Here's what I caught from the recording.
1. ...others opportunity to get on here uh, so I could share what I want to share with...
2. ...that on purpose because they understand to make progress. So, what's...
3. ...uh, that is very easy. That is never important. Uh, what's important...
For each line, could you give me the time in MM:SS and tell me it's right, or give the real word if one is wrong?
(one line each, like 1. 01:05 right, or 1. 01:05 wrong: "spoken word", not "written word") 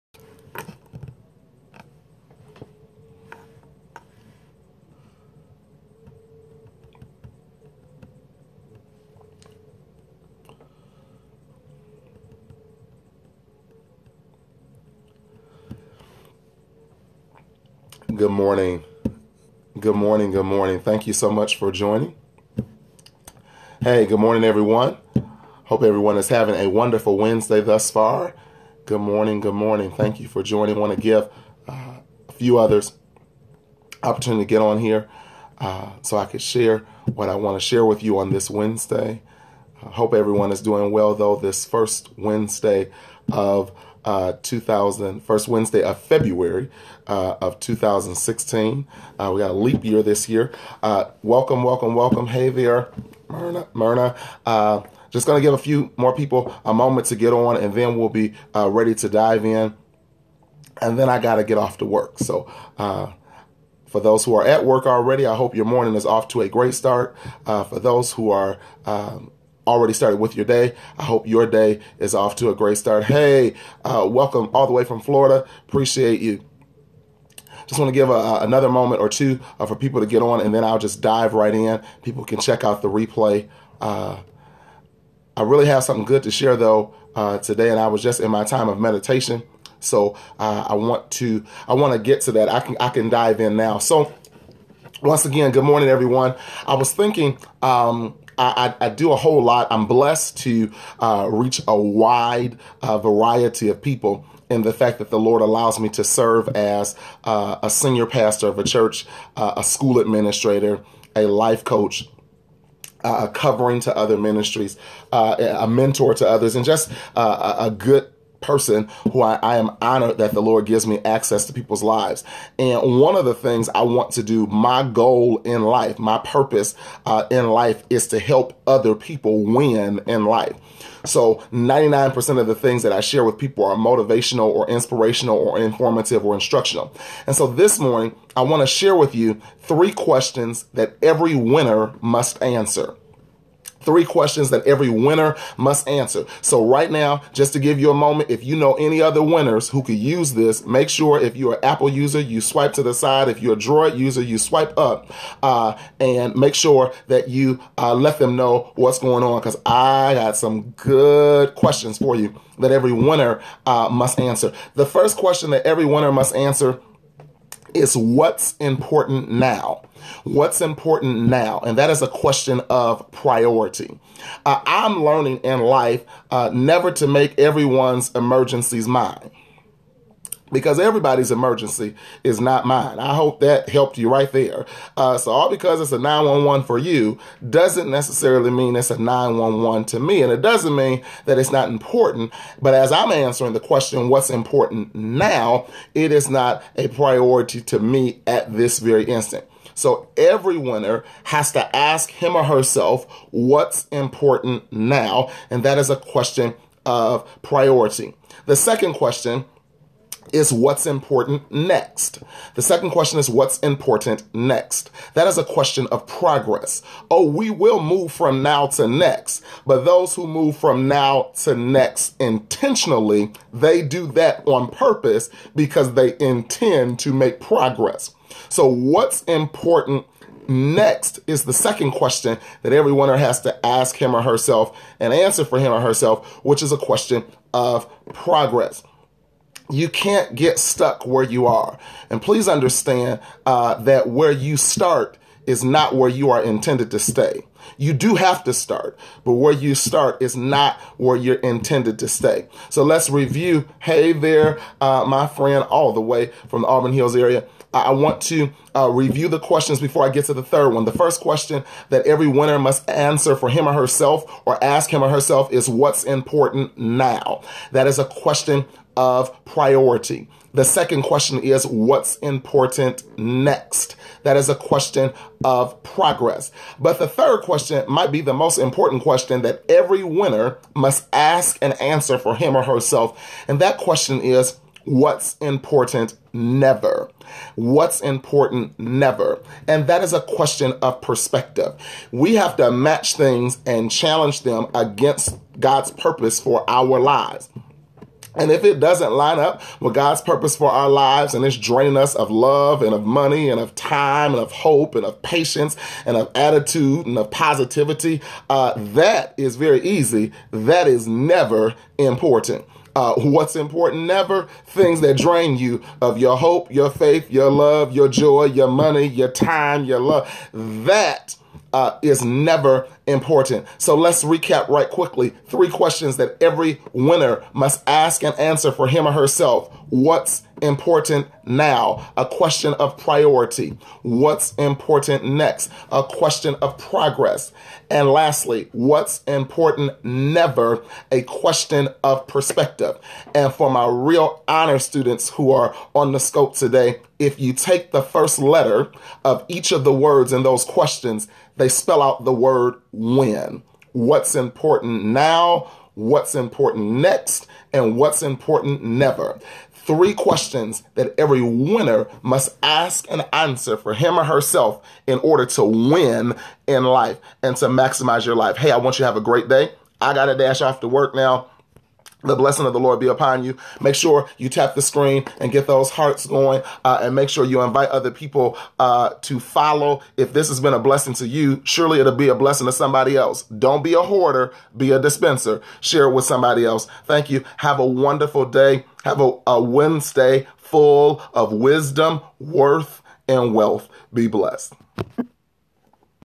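1. 00:32 right
2. 03:44 wrong: "intend", not "understand"
3. 05:08 right.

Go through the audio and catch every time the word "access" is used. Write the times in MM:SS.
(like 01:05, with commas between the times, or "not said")
02:01.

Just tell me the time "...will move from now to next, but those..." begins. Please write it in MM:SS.
03:37.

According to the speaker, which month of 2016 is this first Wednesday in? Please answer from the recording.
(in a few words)
February.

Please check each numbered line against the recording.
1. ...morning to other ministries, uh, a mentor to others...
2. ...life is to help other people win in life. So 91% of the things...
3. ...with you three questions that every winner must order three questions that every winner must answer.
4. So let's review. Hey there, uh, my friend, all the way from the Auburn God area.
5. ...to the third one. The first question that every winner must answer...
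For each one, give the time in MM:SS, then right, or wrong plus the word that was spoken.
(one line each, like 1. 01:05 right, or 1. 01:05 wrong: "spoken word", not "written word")
1. 01:53 wrong: "covering", not "morning"
2. 02:07 wrong: "99", not "91"
3. 02:18 wrong: "answer", not "order"
4. 04:12 wrong: "Hills", not "God"
5. 04:20 right.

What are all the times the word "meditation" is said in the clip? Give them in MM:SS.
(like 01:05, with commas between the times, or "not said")
01:28.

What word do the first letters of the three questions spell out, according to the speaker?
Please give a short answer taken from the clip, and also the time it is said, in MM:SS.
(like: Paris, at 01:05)
When, at 05:52.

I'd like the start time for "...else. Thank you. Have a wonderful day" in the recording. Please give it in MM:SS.
06:26.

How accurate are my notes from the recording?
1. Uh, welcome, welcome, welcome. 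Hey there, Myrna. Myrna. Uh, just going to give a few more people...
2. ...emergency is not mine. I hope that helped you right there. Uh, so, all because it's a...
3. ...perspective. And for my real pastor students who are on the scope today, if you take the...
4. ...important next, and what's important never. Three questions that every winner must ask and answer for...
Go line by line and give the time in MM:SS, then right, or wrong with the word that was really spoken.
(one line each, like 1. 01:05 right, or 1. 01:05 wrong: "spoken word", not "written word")
1. 00:50 right
2. 03:01 right
3. 05:42 wrong: "honor", not "pastor"
4. 05:56 right.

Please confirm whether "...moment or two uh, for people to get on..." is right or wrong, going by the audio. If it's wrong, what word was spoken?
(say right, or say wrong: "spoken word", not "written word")
right.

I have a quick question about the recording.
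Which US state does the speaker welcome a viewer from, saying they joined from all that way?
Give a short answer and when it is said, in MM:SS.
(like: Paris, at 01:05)
Florida, at 01:15.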